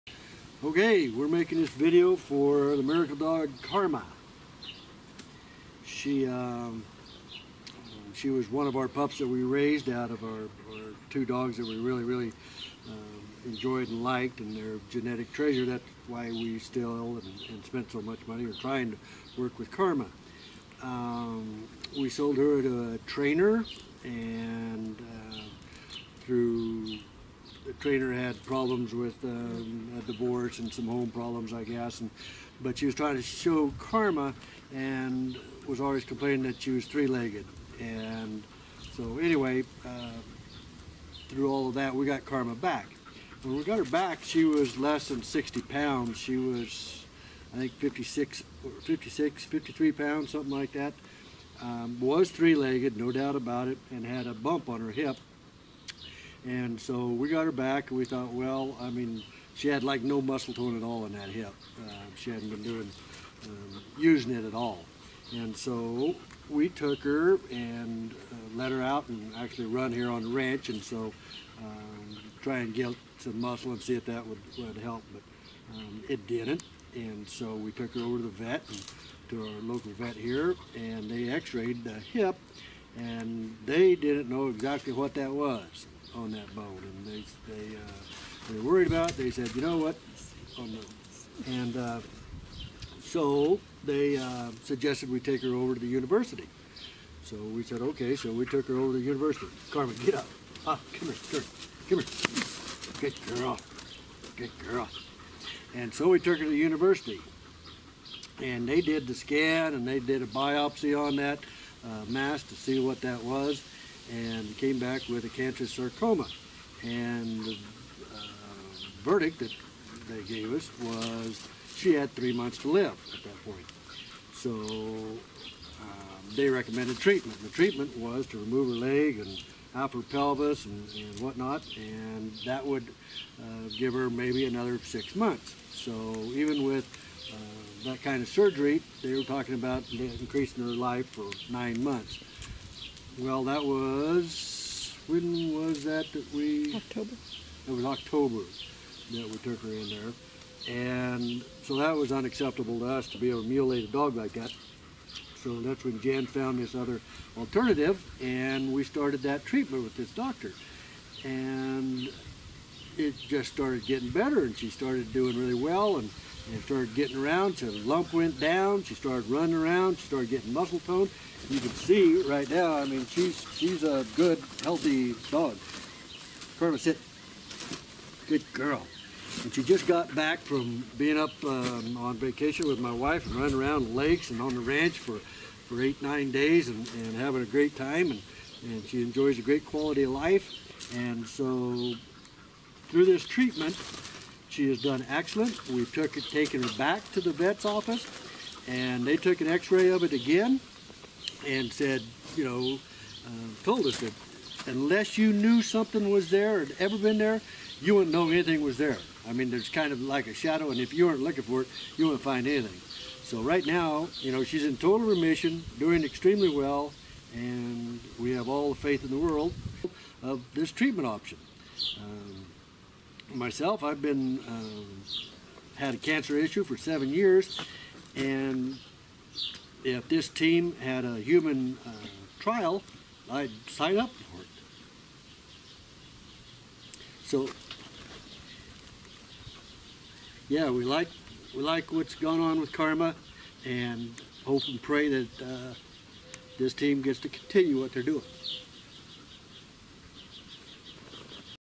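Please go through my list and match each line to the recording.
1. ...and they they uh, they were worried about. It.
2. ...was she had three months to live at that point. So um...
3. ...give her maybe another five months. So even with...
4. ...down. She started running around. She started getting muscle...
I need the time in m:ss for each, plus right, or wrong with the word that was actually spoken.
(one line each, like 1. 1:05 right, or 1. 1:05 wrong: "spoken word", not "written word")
1. 1:26 right
2. 2:00 right
3. 2:13 wrong: "six", not "five"
4. 2:48 right.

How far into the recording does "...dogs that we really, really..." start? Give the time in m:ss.
0:11.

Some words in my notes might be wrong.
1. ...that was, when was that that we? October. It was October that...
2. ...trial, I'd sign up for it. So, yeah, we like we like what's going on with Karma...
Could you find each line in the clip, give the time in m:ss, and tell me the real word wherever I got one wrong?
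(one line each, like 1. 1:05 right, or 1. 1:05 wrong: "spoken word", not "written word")
1. 2:23 right
2. 3:52 right.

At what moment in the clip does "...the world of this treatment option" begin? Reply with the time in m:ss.
3:39.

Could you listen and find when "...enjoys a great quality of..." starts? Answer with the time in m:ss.
3:09.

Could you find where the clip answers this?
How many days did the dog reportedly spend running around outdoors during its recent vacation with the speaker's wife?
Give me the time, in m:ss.
3:05.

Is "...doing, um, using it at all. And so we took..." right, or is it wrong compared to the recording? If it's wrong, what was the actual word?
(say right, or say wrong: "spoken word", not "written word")
right.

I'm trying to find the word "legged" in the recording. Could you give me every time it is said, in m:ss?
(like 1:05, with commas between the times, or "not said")
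0:36, 0:52.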